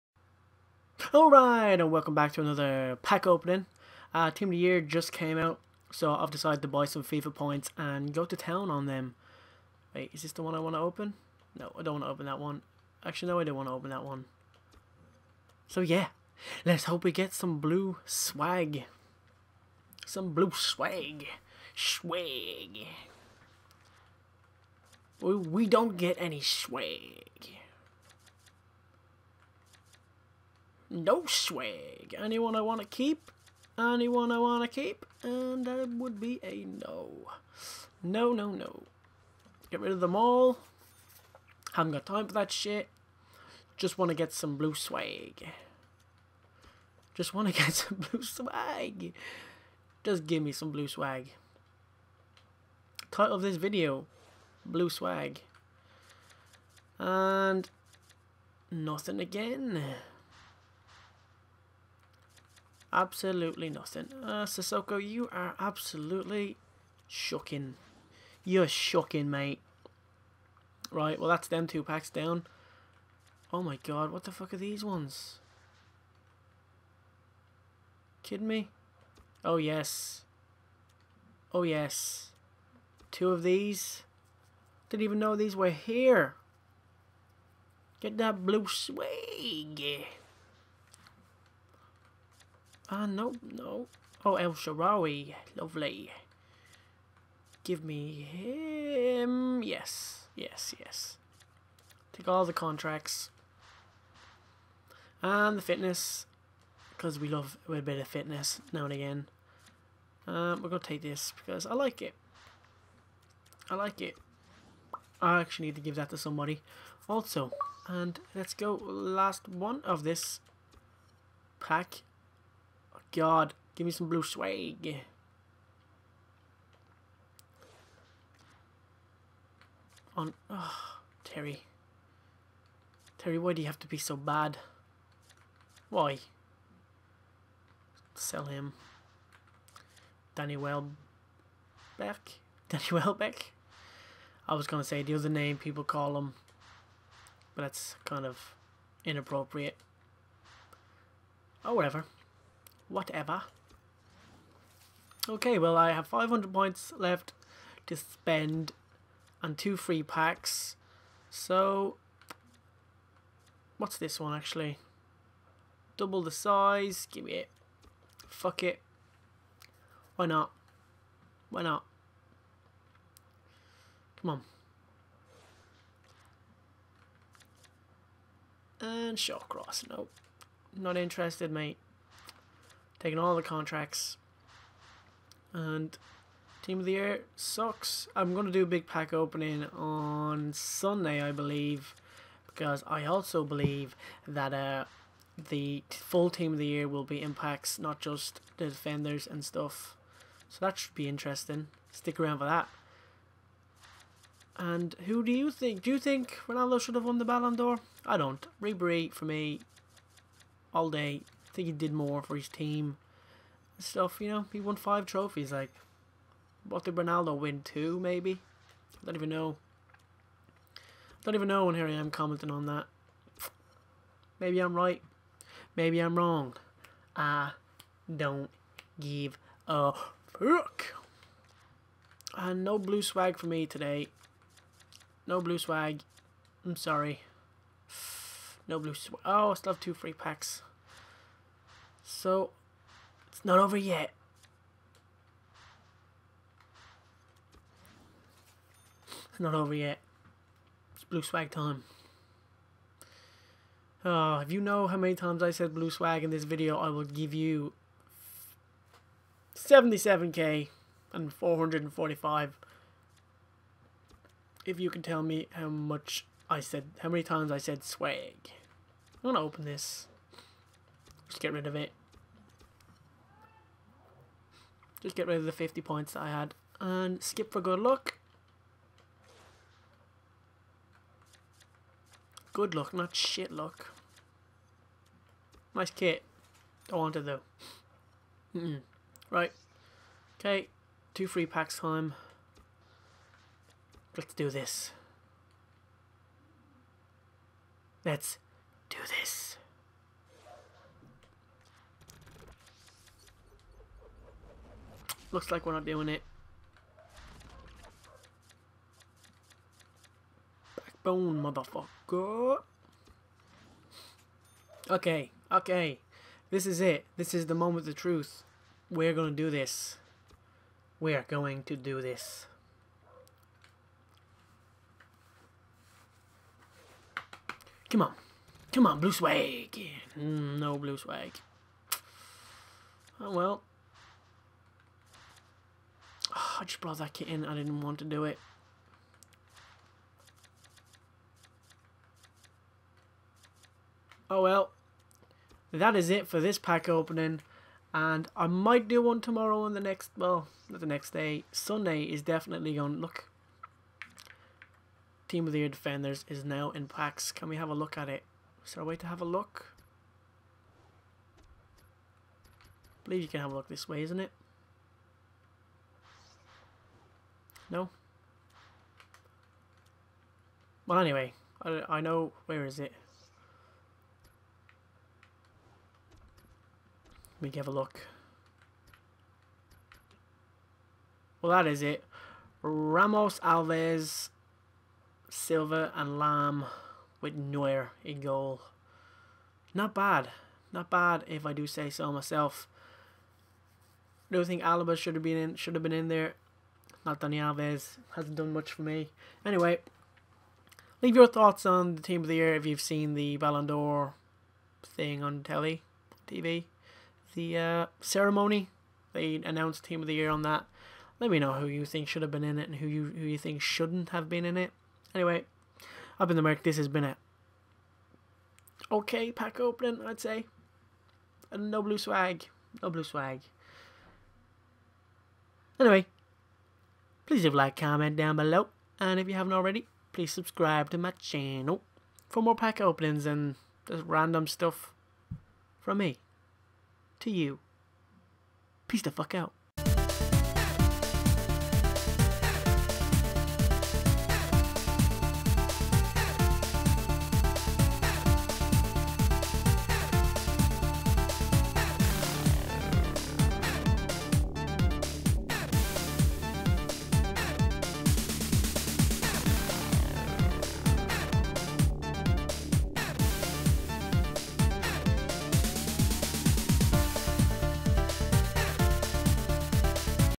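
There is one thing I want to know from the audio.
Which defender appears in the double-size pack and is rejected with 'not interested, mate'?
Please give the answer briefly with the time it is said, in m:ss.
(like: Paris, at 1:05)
Shawcross, at 2:59.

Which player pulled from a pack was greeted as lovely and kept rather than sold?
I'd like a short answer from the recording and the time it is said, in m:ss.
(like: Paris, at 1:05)
El Shaarawy, at 1:34.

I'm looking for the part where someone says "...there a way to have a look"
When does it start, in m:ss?
5:58.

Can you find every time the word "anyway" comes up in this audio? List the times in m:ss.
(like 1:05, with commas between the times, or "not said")
6:10, 6:39, 6:55, 7:05.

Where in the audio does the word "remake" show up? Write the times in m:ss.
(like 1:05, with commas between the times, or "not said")
not said.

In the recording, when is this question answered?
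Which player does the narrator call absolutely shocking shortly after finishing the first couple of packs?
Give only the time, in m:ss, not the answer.
1:04.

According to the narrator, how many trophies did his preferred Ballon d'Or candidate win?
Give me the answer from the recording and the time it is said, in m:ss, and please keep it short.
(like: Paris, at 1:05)
5, at 3:34.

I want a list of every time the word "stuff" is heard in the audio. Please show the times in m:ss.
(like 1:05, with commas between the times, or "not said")
3:19, 3:33, 7:14.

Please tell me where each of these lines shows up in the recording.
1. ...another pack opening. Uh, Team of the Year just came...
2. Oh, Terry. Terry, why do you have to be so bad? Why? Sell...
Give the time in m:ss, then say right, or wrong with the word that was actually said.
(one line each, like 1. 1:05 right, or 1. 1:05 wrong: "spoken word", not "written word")
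1. 0:02 right
2. 2:10 right.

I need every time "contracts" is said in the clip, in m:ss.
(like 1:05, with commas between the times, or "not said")
1:42, 3:03.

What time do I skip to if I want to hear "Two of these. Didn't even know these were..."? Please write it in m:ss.
1:23.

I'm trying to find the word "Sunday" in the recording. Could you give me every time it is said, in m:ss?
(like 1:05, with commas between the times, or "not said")
3:10, 5:51.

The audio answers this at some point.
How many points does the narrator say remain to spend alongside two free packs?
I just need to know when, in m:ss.
2:36.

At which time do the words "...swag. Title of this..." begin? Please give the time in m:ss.
0:50.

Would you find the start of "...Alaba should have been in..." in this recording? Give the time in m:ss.
6:34.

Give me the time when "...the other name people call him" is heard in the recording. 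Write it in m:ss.
2:25.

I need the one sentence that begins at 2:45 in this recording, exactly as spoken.
Double the size, give me it.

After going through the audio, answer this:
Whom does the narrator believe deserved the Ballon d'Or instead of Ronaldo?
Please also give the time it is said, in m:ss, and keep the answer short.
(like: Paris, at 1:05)
Ribery, at 3:28.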